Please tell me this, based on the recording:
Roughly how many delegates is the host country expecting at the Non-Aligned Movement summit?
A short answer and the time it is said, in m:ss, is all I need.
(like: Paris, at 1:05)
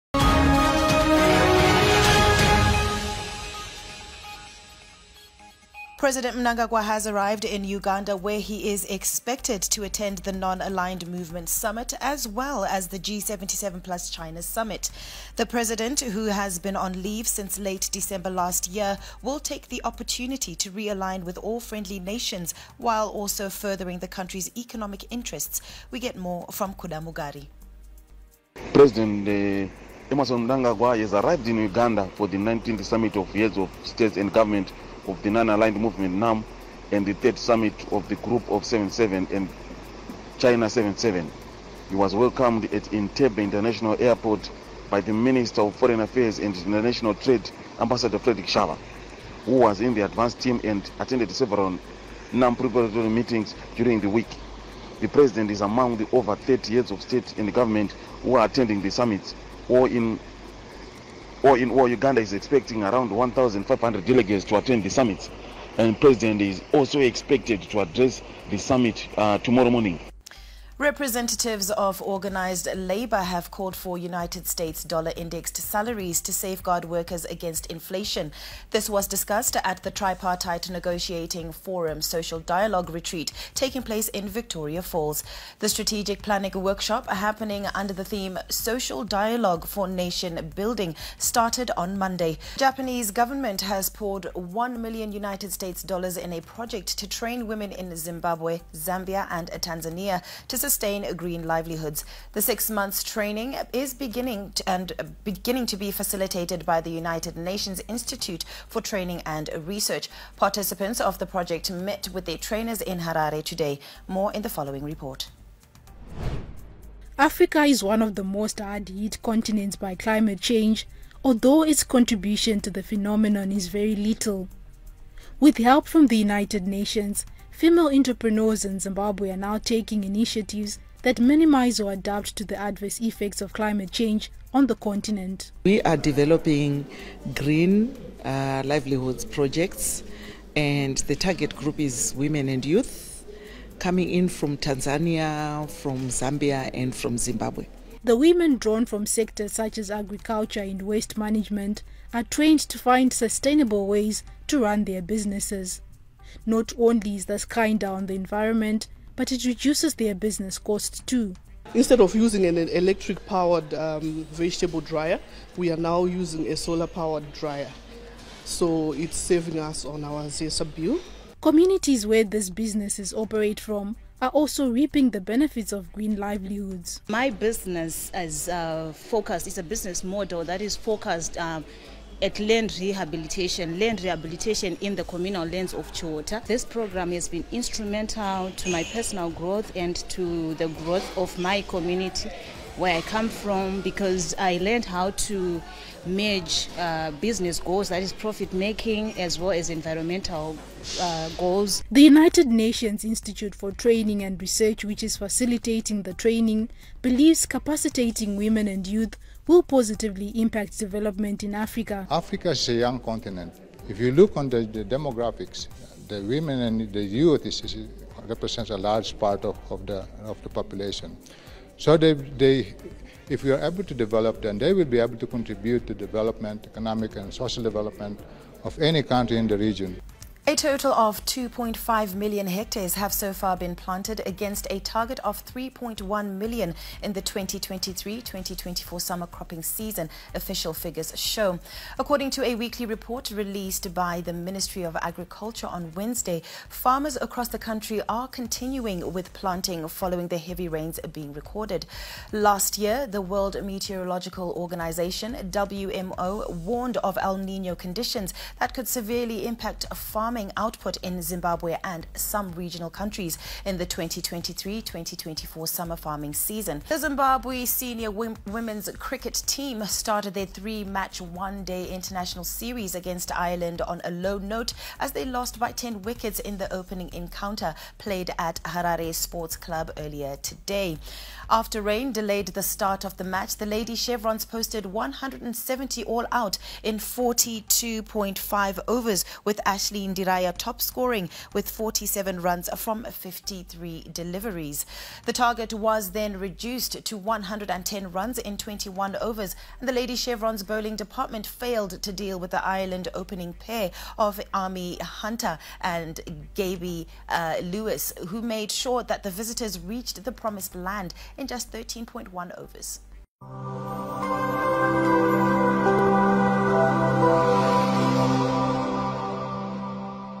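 1,500, at 1:03.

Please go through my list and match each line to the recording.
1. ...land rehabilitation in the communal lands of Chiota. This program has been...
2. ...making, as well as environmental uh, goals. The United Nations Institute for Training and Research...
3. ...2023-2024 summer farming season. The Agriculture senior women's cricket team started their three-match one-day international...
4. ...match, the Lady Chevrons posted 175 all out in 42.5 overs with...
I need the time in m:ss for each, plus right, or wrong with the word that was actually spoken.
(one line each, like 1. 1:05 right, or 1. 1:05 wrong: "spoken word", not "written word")
1. 3:03 right
2. 3:18 right
3. 4:23 wrong: "Zimbabwe", not "Agriculture"
4. 4:43 wrong: "170", not "175".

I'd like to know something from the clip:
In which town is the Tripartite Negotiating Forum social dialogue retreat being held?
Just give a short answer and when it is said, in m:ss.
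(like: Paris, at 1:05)
Victoria Falls, at 1:24.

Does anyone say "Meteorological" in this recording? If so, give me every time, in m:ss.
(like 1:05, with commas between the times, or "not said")
4:13.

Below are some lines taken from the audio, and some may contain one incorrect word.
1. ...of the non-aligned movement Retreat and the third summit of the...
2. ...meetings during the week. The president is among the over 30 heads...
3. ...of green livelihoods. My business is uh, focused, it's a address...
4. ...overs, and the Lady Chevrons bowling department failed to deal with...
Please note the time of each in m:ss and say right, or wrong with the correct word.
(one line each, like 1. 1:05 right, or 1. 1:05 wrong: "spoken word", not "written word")
1. 0:35 wrong: "NAM", not "Retreat"
2. 0:53 right
3. 2:55 wrong: "business", not "address"
4. 4:59 right.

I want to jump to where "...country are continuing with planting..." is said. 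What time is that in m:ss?
4:07.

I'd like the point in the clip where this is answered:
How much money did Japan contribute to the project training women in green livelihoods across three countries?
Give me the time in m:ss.
1:34.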